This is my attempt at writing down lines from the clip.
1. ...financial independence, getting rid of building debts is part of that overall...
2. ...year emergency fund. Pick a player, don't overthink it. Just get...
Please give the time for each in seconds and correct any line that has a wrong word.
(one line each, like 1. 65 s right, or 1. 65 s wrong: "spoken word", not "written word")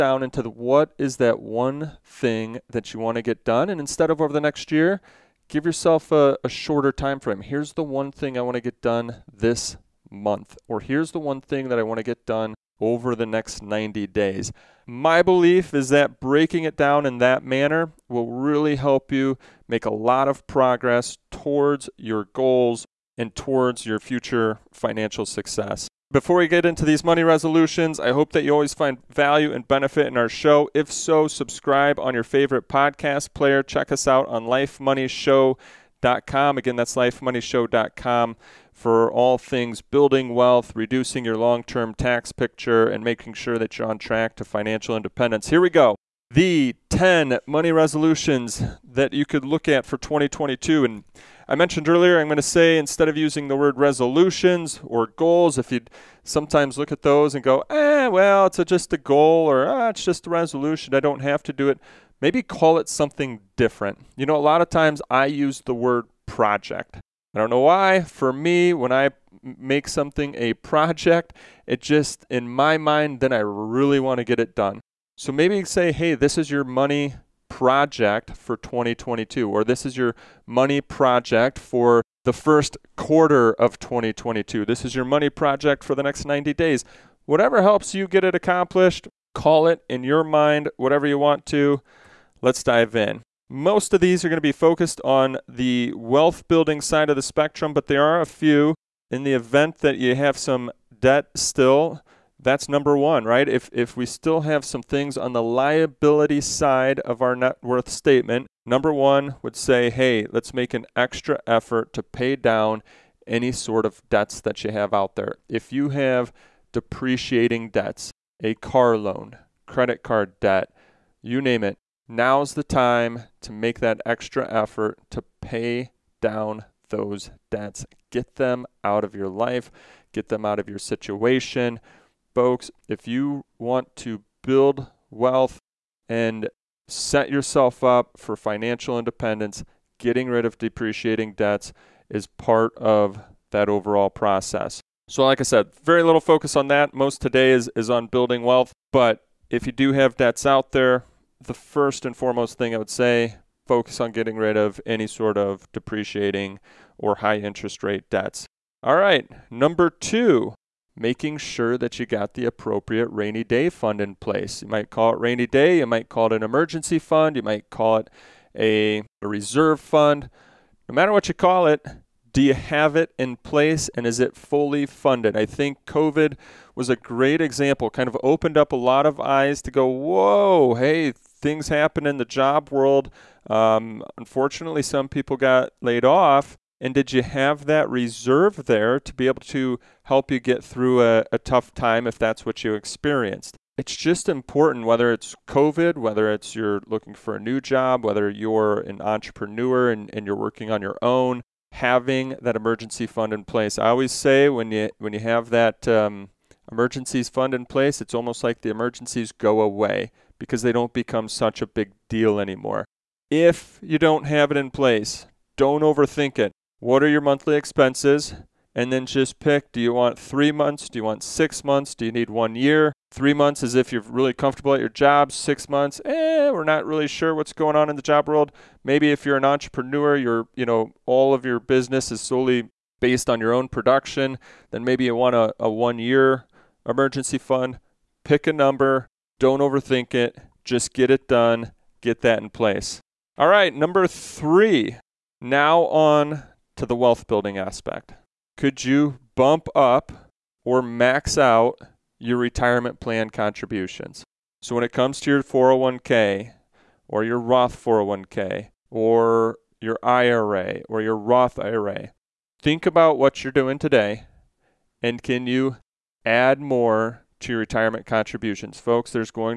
1. 138 s wrong: "depreciating", not "building"
2. 235 s wrong: "number", not "player".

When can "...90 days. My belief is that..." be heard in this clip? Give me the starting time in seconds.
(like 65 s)
13 s.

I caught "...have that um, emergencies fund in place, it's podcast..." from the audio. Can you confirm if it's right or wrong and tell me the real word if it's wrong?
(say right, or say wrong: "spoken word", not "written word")
wrong: "almost", not "podcast".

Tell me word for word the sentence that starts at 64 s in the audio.
You know, a lot of times I use the word project.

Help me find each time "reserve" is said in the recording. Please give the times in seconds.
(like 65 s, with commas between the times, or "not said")
169 s, 187 s.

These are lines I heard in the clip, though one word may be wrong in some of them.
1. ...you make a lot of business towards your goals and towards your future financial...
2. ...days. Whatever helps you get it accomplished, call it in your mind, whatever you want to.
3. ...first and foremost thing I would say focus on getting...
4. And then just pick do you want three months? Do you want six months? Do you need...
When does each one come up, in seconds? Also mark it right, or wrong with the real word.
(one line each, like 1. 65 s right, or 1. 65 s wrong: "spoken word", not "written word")
1. 19 s wrong: "progress", not "business"
2. 86 s right
3. 151 s right
4. 218 s right.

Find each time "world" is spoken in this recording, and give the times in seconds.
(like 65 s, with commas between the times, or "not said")
182 s, 228 s.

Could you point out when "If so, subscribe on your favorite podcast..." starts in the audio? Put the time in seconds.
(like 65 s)
30 s.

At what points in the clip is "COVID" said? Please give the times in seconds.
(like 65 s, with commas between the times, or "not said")
175 s, 195 s.